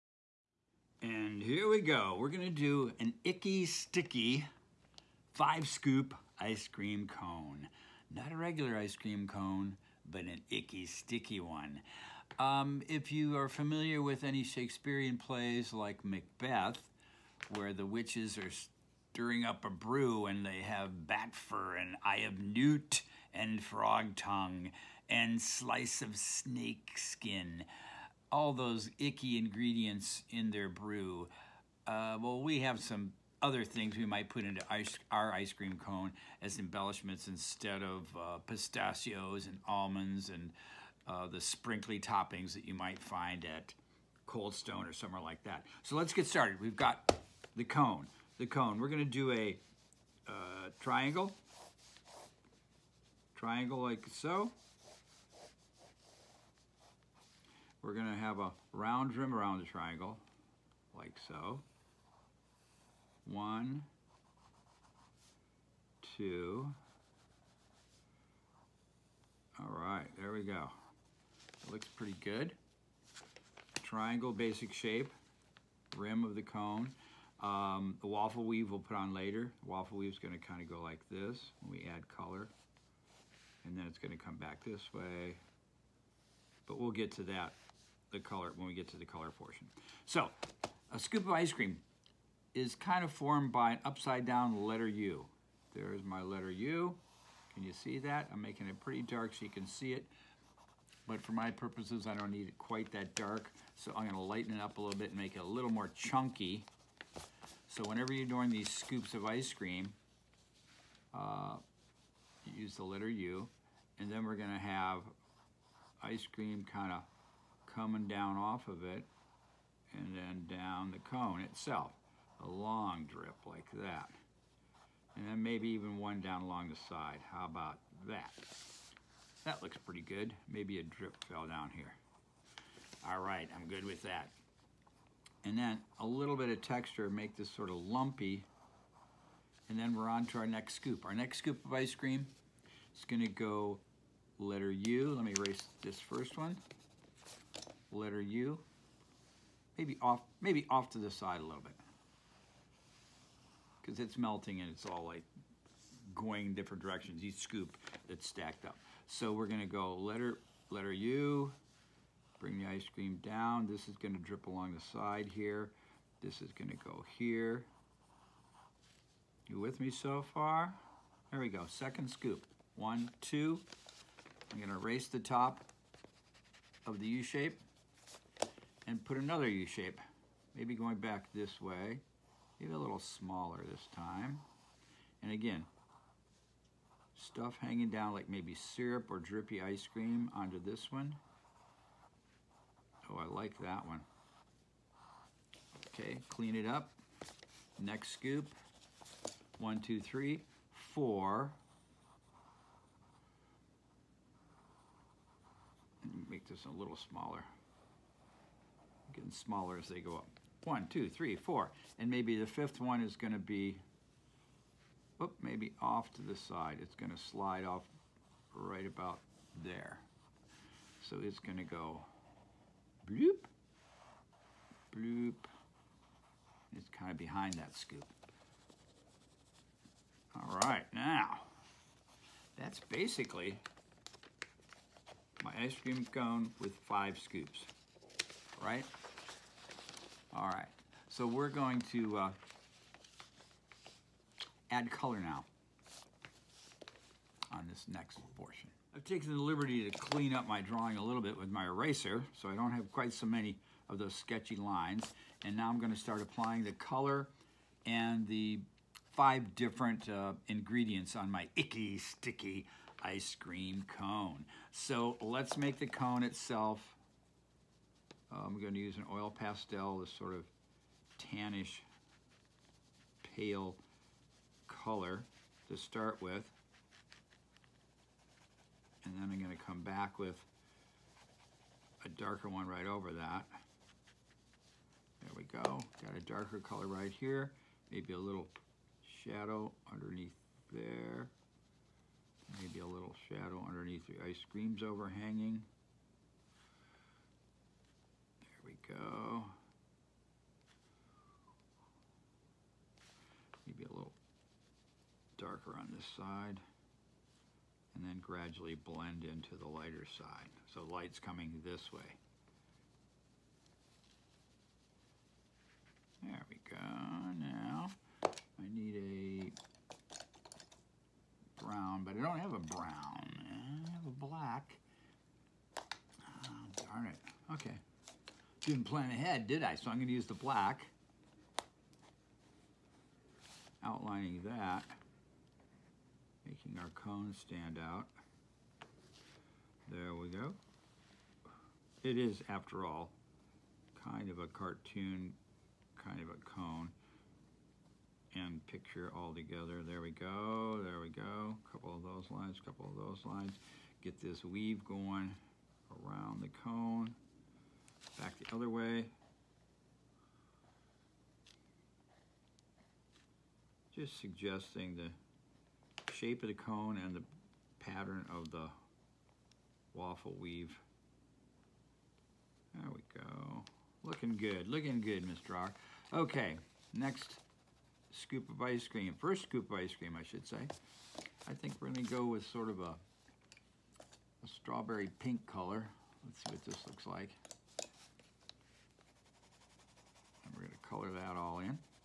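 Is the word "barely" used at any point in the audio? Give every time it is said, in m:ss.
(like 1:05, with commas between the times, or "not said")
not said.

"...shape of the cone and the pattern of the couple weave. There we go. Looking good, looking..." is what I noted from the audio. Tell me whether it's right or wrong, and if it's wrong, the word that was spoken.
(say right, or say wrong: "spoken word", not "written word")
wrong: "waffle", not "couple".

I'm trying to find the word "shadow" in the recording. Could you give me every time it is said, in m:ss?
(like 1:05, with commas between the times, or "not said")
4:49, 4:53.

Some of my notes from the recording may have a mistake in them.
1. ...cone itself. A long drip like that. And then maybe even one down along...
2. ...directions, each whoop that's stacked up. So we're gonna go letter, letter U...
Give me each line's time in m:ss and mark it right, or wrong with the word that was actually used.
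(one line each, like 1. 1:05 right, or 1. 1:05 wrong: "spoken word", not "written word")
1. 2:01 right
2. 2:36 wrong: "scoop", not "whoop".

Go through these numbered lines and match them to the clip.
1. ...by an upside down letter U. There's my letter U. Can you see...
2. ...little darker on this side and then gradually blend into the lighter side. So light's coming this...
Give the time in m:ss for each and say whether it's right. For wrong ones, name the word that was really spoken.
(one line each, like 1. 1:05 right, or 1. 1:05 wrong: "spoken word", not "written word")
1. 1:33 right
2. 5:03 right.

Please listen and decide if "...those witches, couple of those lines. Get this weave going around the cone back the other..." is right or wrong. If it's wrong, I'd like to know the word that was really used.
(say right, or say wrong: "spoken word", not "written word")
wrong: "lines", not "witches".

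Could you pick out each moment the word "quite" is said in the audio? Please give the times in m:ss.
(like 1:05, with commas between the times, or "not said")
1:42, 4:12.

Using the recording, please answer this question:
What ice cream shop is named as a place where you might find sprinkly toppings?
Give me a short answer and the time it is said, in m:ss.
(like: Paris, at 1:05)
Cold Stone, at 0:44.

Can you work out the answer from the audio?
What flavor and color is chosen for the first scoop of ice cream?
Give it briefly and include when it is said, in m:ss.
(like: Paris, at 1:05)
Strawberry pink, at 6:24.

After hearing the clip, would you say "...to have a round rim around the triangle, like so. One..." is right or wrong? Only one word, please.
right.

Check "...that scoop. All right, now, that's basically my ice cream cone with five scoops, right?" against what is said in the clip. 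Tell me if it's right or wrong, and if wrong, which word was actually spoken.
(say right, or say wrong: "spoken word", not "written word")
right.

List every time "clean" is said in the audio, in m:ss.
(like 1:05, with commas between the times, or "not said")
3:16, 4:09.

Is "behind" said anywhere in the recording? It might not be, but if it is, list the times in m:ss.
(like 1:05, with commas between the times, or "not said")
3:47.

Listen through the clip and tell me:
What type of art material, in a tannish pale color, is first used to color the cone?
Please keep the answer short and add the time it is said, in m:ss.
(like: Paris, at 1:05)
Oil pastel, at 4:29.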